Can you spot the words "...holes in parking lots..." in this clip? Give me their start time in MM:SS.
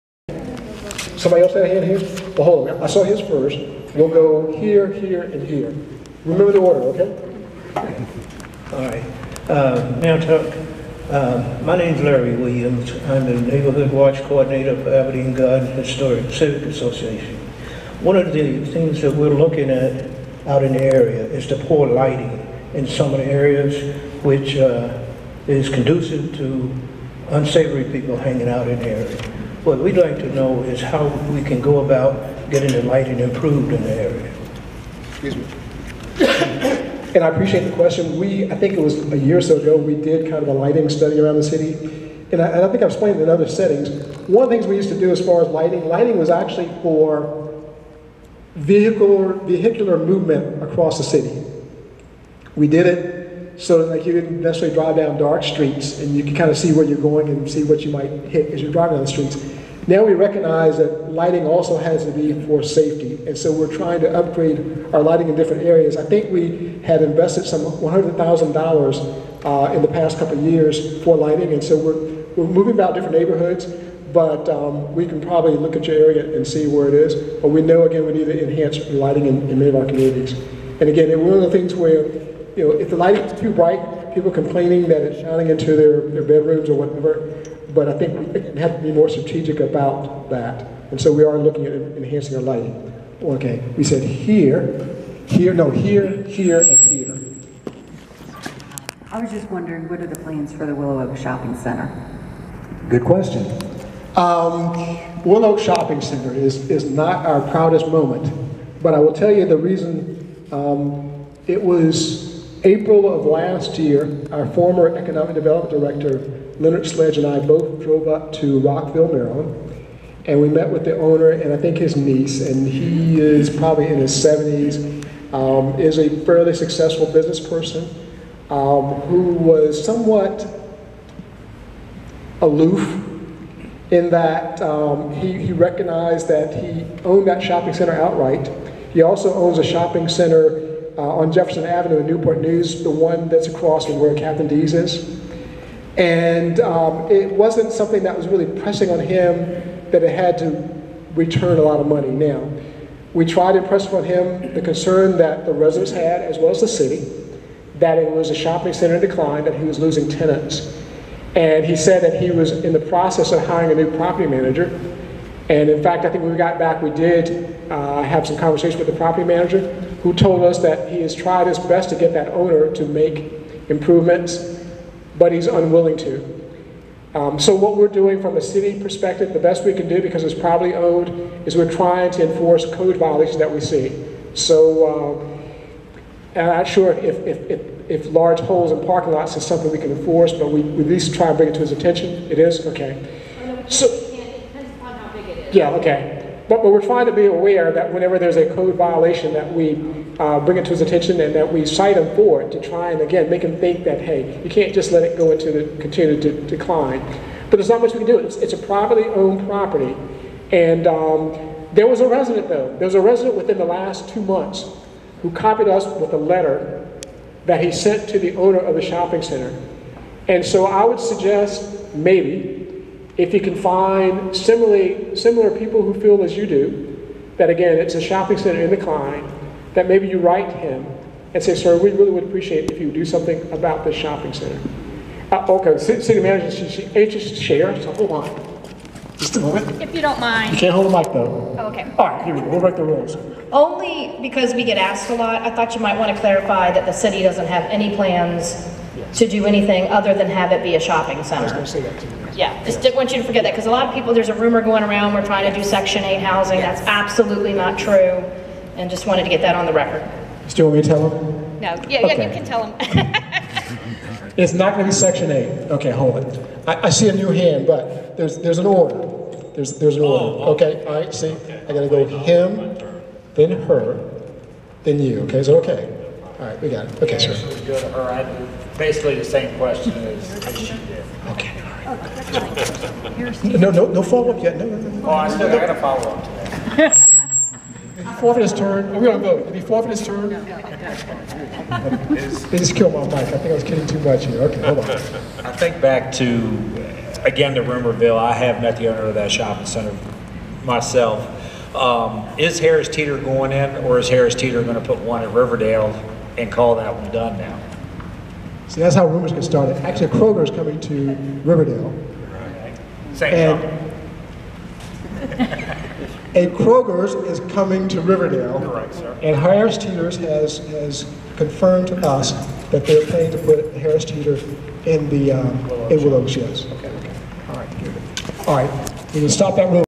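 03:08.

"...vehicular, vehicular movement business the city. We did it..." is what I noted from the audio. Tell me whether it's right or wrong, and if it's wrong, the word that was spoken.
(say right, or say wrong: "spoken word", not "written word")
wrong: "across", not "business".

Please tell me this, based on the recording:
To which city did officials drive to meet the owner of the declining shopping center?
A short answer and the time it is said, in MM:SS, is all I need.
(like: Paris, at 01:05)
Rockville, Maryland, at 01:58.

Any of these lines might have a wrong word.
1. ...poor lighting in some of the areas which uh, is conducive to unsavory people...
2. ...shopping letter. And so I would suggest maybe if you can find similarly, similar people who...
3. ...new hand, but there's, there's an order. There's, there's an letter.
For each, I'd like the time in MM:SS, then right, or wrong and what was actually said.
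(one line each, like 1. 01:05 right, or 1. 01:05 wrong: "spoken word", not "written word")
1. 00:21 right
2. 03:38 wrong: "center", not "letter"
3. 04:27 wrong: "order", not "letter".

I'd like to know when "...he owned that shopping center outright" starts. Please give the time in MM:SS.
02:16.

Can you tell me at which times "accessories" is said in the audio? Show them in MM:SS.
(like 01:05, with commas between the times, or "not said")
not said.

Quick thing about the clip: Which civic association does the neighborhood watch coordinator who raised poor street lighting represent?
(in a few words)
Aberdeen Garden Historic Civic Association.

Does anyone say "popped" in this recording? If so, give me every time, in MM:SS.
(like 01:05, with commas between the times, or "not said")
not said.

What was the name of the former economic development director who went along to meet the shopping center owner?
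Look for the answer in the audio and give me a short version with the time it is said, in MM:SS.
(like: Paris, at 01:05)
Leonard Sledge, at 01:56.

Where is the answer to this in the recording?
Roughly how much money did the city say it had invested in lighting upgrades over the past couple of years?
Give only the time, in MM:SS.
01:07.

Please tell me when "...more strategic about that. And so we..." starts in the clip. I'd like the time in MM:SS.
01:28.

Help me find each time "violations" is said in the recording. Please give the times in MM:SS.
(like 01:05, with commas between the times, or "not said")
03:02, 03:18.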